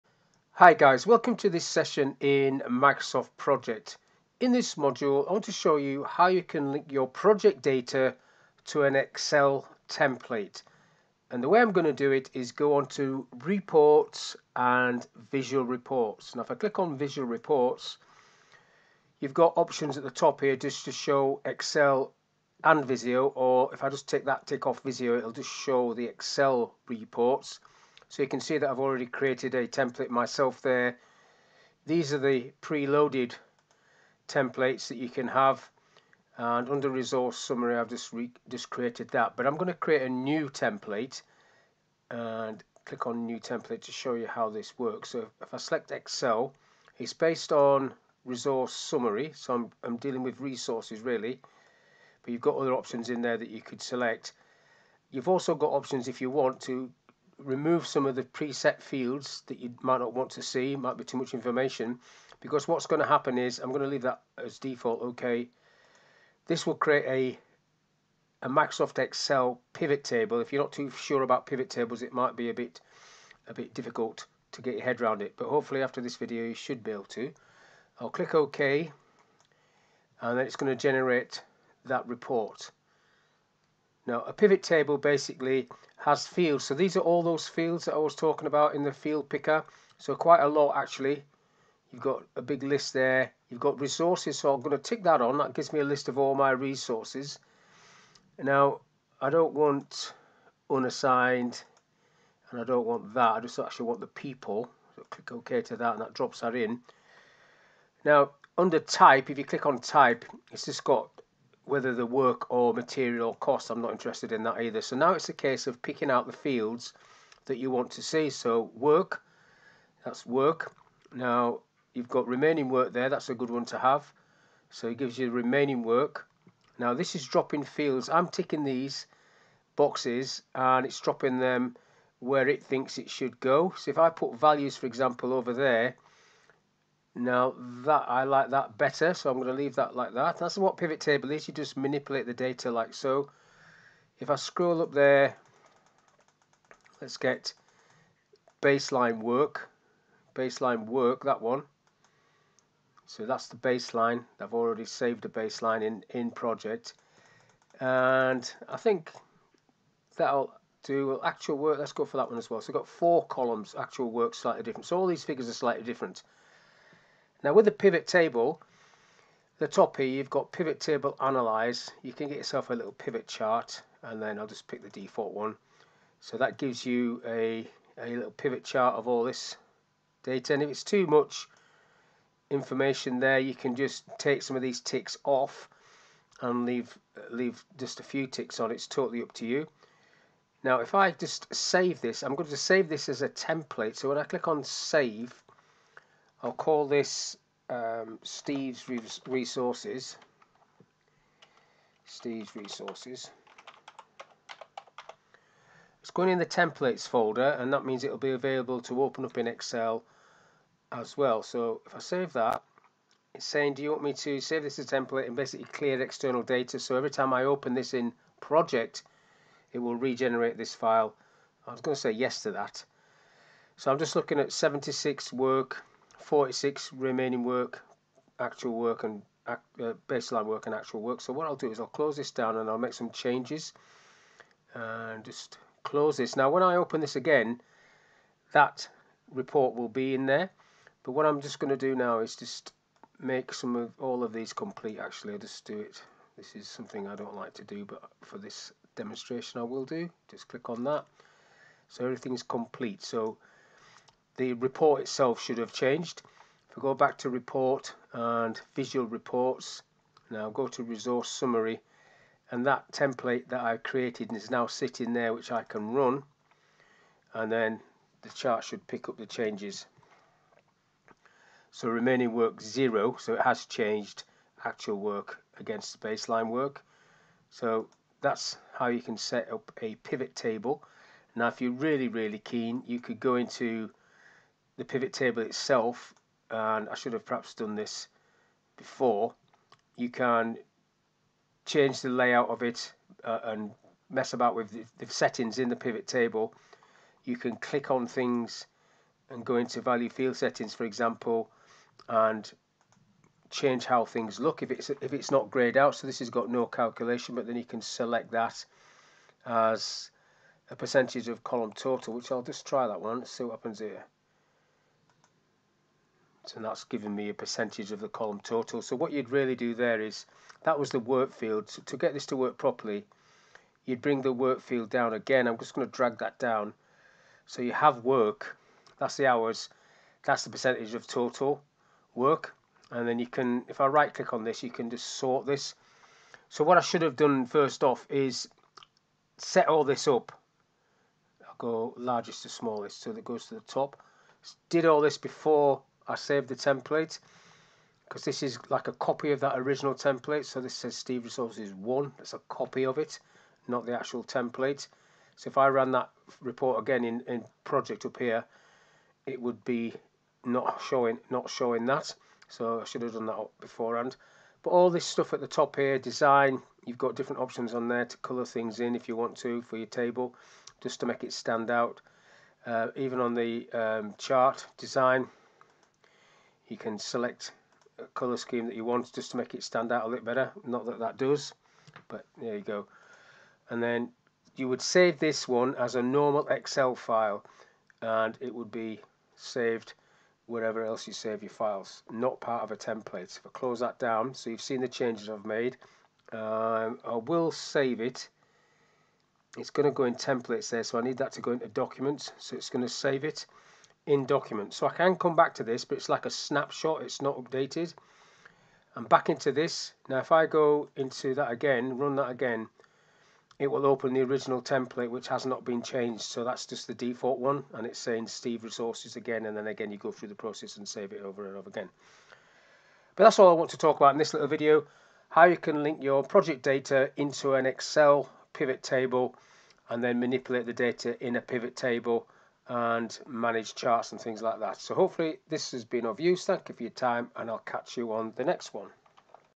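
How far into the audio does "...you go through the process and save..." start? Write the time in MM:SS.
06:59.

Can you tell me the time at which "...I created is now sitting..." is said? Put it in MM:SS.
04:23.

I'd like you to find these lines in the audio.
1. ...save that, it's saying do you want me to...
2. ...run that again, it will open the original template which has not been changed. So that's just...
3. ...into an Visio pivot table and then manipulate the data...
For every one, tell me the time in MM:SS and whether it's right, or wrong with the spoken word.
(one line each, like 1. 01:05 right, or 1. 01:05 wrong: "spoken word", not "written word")
1. 03:31 right
2. 06:51 right
3. 07:07 wrong: "Excel", not "Visio".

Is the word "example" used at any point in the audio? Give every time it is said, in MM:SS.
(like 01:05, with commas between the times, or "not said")
02:14, 05:00.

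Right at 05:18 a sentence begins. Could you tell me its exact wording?
So what you'd really do there is, that was the work field.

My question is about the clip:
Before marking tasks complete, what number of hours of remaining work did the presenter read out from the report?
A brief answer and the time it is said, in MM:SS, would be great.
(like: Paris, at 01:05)
46, at 03:46.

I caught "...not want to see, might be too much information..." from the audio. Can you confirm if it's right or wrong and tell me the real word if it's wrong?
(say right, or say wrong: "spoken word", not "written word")
right.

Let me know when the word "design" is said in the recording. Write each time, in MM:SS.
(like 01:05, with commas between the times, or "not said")
06:05, 06:14.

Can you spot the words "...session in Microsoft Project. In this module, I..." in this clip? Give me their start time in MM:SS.
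00:01.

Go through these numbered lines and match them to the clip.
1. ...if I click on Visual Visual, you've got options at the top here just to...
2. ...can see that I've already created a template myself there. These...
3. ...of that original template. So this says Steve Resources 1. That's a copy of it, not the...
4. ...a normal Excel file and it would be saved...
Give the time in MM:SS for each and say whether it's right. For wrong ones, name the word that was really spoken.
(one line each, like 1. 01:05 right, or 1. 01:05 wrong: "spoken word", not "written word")
1. 00:16 wrong: "Reports", not "Visual"
2. 00:28 right
3. 05:49 right
4. 06:25 right.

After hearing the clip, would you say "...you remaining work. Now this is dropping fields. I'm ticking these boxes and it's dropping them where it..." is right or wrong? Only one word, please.
right.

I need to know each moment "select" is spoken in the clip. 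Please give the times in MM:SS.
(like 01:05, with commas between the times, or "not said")
00:45, 00:53, 05:07, 06:16.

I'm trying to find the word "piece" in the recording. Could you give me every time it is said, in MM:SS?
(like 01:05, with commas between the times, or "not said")
not said.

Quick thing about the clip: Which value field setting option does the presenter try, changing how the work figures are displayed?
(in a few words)
Percentage of column total.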